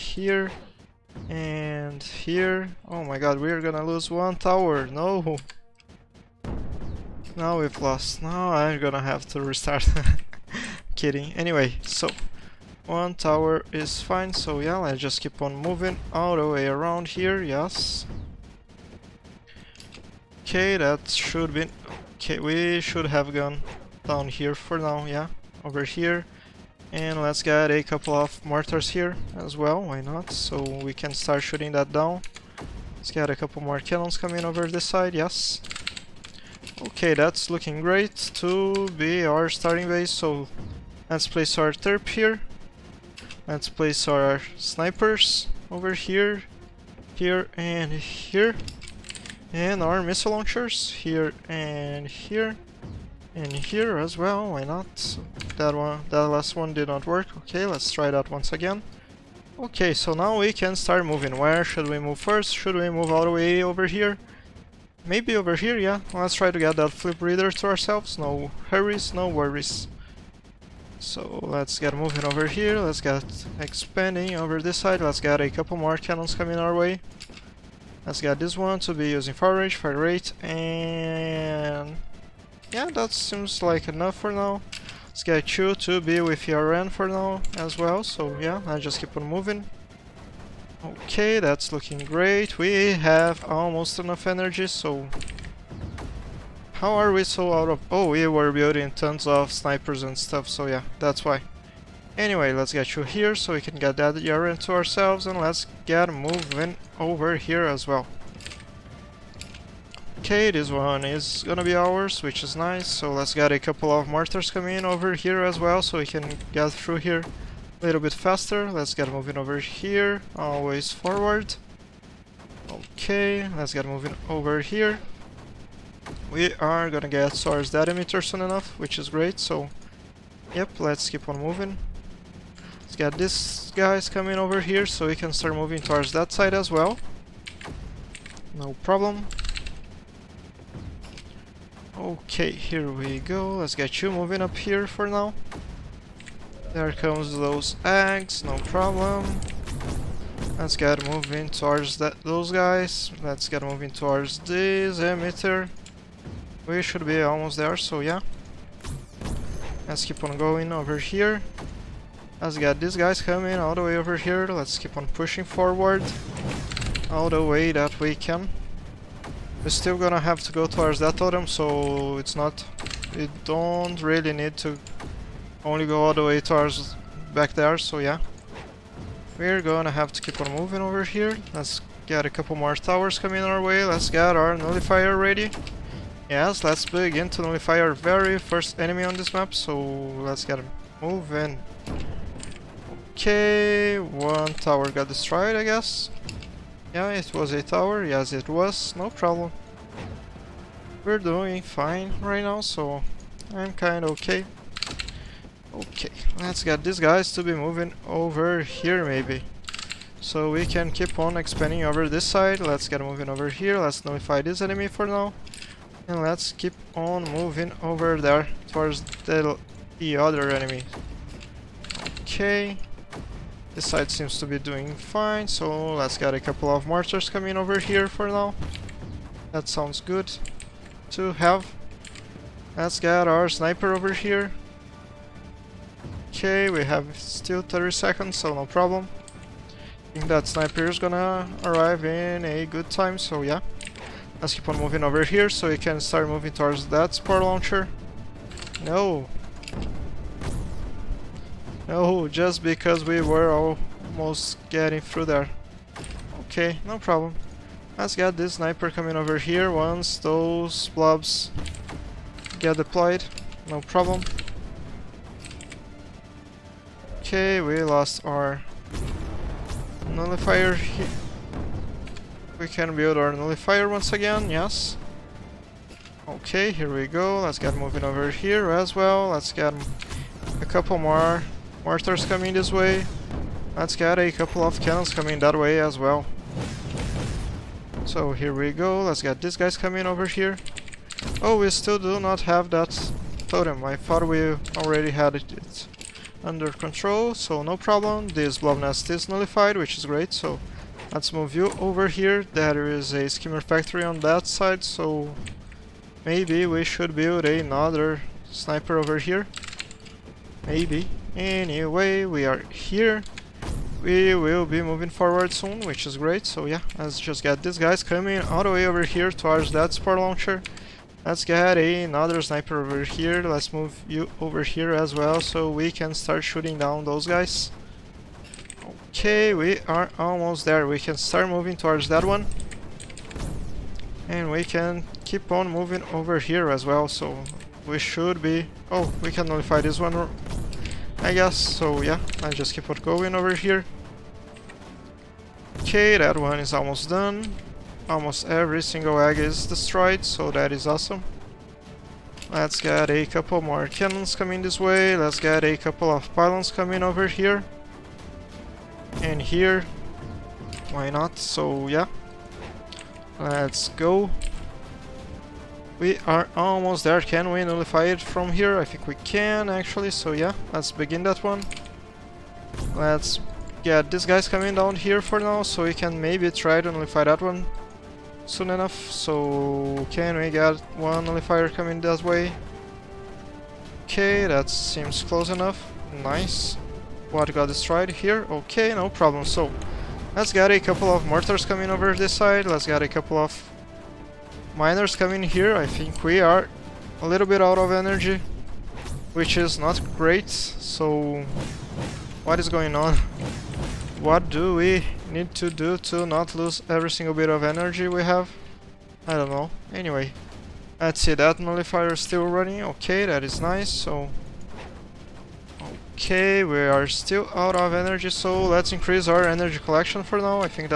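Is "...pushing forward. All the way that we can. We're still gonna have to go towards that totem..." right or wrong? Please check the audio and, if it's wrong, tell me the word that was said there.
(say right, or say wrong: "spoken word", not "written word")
right.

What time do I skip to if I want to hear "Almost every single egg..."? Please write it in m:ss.
5:48.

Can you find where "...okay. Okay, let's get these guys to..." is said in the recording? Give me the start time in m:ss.
3:24.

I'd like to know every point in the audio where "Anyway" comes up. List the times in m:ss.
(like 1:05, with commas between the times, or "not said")
0:11, 1:42, 5:11, 6:49.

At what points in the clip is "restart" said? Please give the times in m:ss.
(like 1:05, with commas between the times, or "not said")
0:09.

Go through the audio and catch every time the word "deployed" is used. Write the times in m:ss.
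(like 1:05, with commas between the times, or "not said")
4:22.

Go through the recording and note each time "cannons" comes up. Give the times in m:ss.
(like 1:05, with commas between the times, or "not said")
0:33, 1:15, 4:44, 5:53.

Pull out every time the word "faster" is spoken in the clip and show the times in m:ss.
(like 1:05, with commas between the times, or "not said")
1:58.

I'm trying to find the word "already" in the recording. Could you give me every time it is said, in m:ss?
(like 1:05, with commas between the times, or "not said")
4:54.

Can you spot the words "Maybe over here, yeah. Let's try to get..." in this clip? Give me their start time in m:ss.
1:05.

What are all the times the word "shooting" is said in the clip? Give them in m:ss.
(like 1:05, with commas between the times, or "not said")
0:31, 5:26.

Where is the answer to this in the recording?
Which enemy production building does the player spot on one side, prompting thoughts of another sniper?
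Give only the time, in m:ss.
5:03.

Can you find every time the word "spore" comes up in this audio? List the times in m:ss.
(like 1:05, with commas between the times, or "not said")
4:07, 5:19.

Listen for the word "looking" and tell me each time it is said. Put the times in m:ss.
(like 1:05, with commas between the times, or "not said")
0:37, 1:31.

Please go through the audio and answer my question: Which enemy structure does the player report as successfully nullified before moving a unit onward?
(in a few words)
Blob nest.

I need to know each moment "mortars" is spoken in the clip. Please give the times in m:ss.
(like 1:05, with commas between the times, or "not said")
0:28, 1:54, 3:46, 4:41, 6:31.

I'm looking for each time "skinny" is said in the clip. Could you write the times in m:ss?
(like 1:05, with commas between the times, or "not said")
not said.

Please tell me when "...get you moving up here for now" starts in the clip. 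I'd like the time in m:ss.
2:23.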